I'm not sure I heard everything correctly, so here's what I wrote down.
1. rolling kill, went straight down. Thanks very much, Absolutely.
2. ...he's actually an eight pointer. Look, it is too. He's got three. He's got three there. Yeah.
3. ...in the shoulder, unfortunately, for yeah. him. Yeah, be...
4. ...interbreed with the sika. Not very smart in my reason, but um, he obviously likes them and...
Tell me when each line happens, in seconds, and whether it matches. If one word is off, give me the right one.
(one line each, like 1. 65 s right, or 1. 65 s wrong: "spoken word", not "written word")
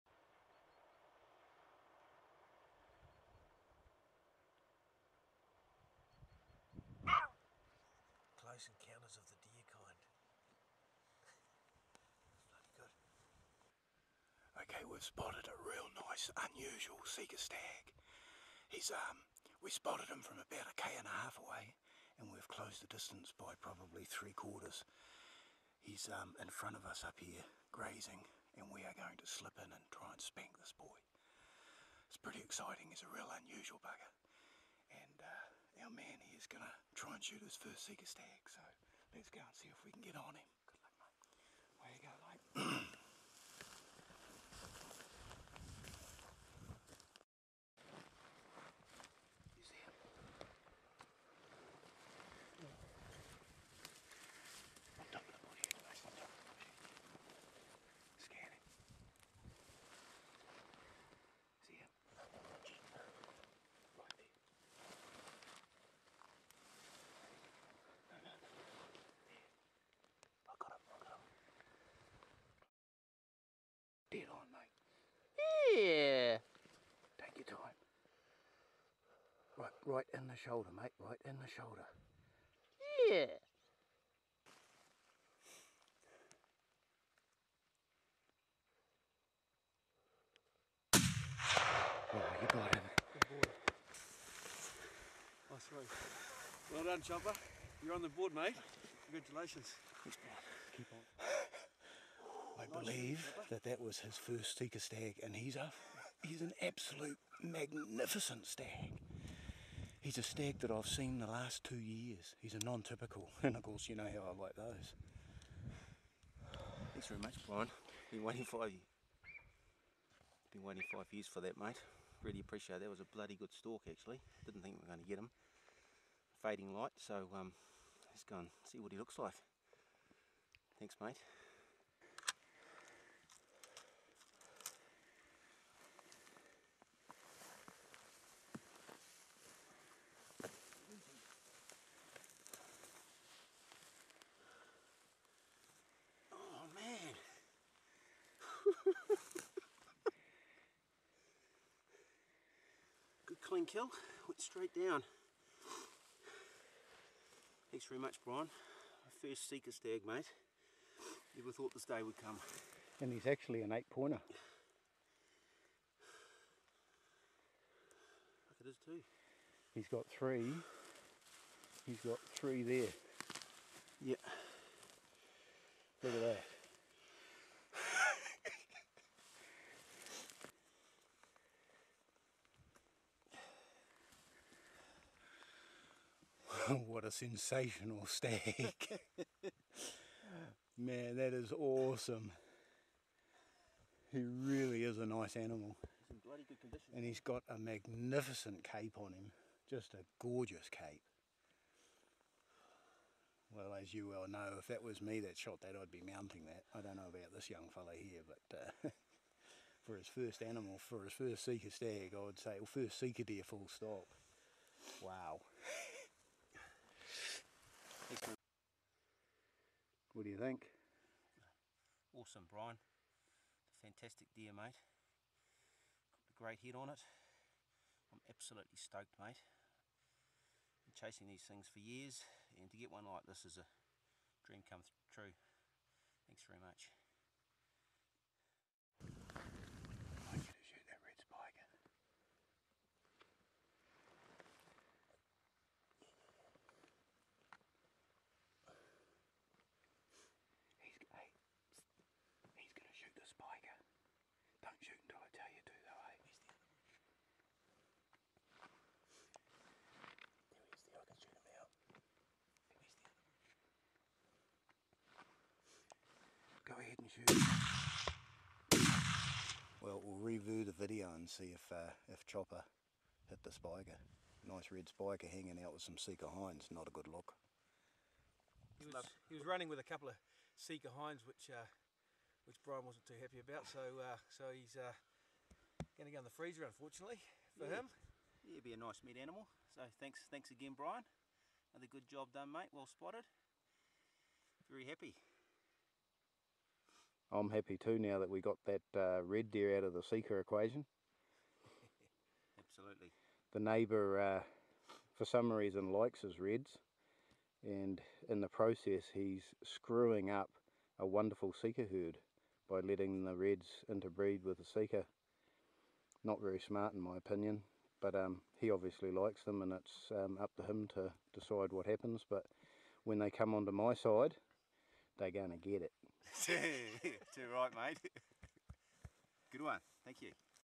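1. 153 s wrong: "Brian", not "Absolutely"
2. 163 s right
3. 286 s wrong: "freezer", not "shoulder"
4. 313 s wrong: "opinion", not "reason".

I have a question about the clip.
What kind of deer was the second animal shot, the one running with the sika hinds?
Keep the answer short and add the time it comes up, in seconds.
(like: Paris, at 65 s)
Red spiker, at 274 s.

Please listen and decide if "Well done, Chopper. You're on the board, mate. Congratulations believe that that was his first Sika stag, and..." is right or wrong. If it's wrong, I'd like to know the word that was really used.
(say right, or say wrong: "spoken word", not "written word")
right.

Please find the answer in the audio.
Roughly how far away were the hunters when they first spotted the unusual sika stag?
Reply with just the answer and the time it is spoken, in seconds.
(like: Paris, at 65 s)
1.5 km, at 20 s.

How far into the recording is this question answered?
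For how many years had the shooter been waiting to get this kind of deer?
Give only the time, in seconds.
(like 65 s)
120 s.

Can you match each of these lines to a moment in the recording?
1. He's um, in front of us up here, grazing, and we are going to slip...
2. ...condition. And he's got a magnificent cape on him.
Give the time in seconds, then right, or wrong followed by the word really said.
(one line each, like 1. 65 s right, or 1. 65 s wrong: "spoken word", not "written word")
1. 25 s right
2. 196 s right.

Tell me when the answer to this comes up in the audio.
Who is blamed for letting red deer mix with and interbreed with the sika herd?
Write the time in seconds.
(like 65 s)
303 s.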